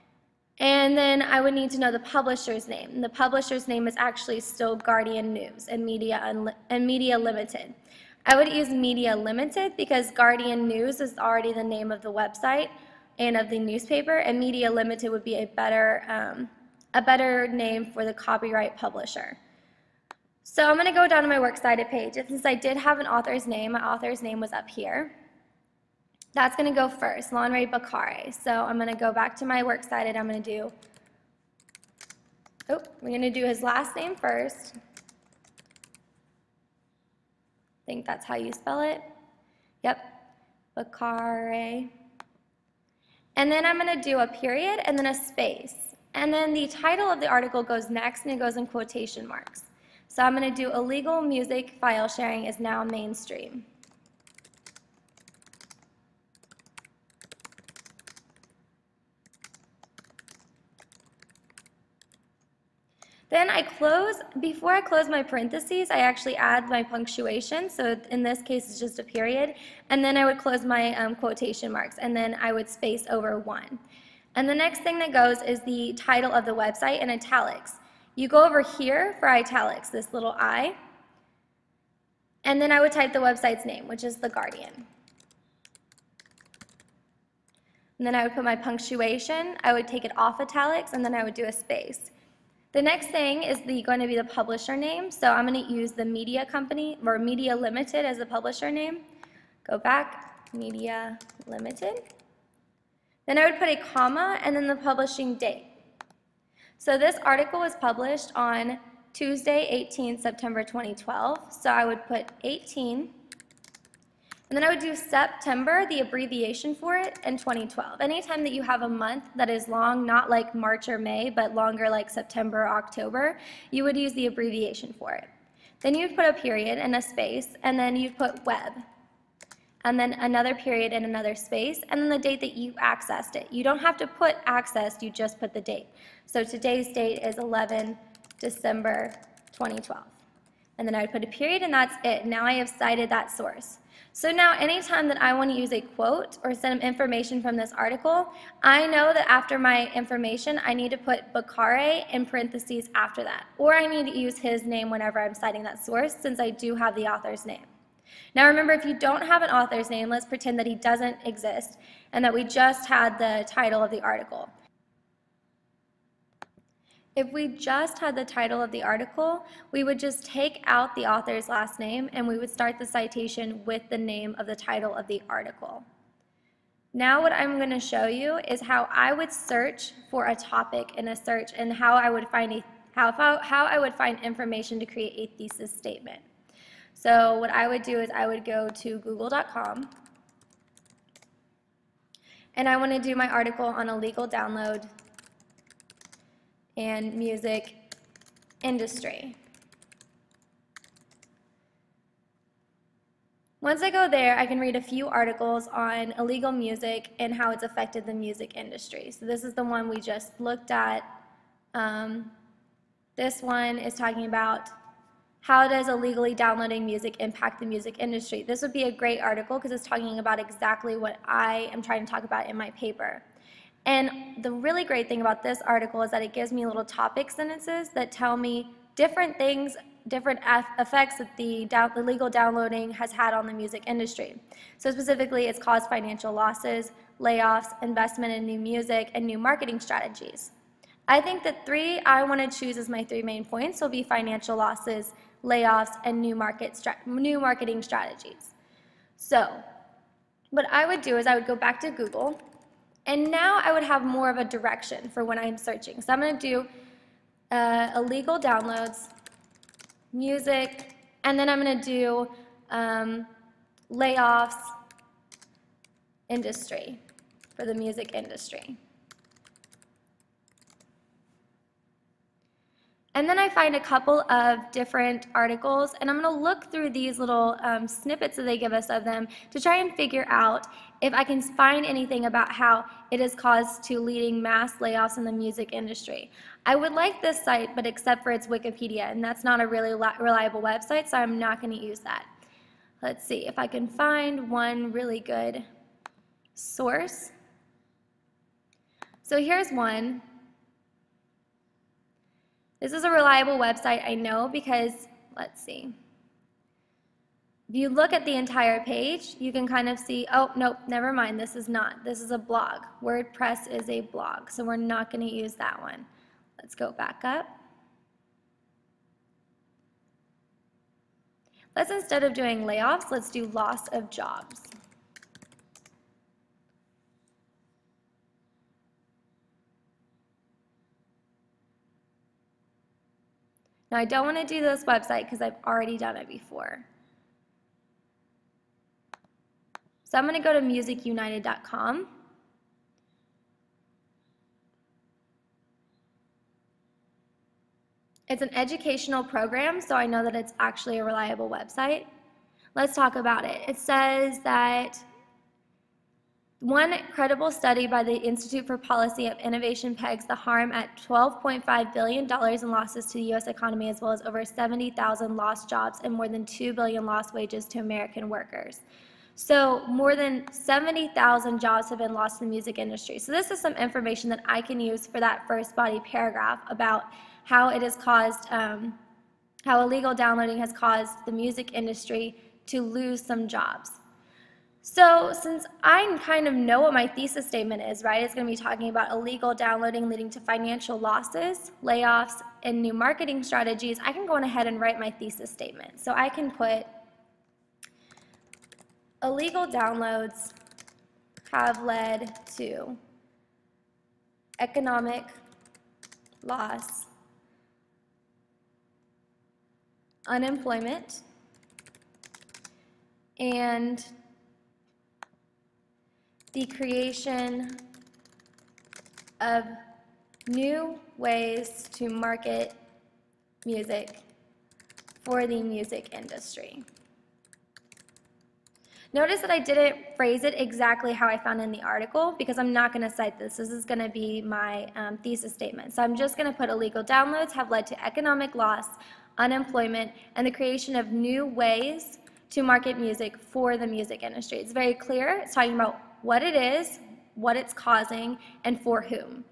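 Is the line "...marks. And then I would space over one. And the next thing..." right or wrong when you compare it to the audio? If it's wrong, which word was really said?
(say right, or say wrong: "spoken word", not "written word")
right.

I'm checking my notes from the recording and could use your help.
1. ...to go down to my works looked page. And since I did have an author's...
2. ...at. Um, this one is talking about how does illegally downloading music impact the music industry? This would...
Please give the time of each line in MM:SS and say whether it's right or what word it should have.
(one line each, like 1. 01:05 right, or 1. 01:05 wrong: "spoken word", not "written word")
1. 00:20 wrong: "cited", not "looked"
2. 03:30 right.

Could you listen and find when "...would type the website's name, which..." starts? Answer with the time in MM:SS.
01:22.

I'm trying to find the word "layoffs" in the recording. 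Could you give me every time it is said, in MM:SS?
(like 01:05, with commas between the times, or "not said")
03:57, 04:05, 04:23, 04:44, 05:22, 06:31.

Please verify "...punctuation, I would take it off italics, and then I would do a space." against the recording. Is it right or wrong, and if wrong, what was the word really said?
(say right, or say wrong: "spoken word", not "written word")
right.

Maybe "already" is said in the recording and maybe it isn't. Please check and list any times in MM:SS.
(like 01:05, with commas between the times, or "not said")
00:11, 05:35.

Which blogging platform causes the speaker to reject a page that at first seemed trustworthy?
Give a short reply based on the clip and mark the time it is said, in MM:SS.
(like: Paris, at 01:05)
WordPress, at 05:13.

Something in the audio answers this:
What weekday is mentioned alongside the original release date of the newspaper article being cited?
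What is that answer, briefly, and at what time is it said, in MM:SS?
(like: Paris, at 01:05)
Tuesday, at 01:49.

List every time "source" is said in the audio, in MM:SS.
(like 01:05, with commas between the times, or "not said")
02:23, 02:35, 04:56.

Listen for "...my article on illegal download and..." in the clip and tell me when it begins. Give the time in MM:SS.
03:13.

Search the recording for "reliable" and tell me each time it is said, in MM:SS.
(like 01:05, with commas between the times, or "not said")
04:49, 05:03, 05:51.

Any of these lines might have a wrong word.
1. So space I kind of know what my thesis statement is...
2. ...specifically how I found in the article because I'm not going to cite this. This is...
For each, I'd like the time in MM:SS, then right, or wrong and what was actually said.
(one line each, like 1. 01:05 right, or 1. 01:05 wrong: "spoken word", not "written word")
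1. 06:24 wrong: "since", not "space"
2. 07:10 wrong: "exactly", not "specifically".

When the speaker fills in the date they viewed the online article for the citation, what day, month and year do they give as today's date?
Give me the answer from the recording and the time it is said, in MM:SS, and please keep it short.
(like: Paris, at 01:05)
11 December 2012, at 02:17.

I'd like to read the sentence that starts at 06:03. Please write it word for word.
economy, as well as over 70,000 lost jobs and more than 2 billion lost wages to American workers.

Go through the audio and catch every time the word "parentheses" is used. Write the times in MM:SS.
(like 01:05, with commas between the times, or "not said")
01:05, 02:32.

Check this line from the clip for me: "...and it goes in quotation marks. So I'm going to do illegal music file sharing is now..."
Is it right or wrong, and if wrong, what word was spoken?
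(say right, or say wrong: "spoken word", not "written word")
right.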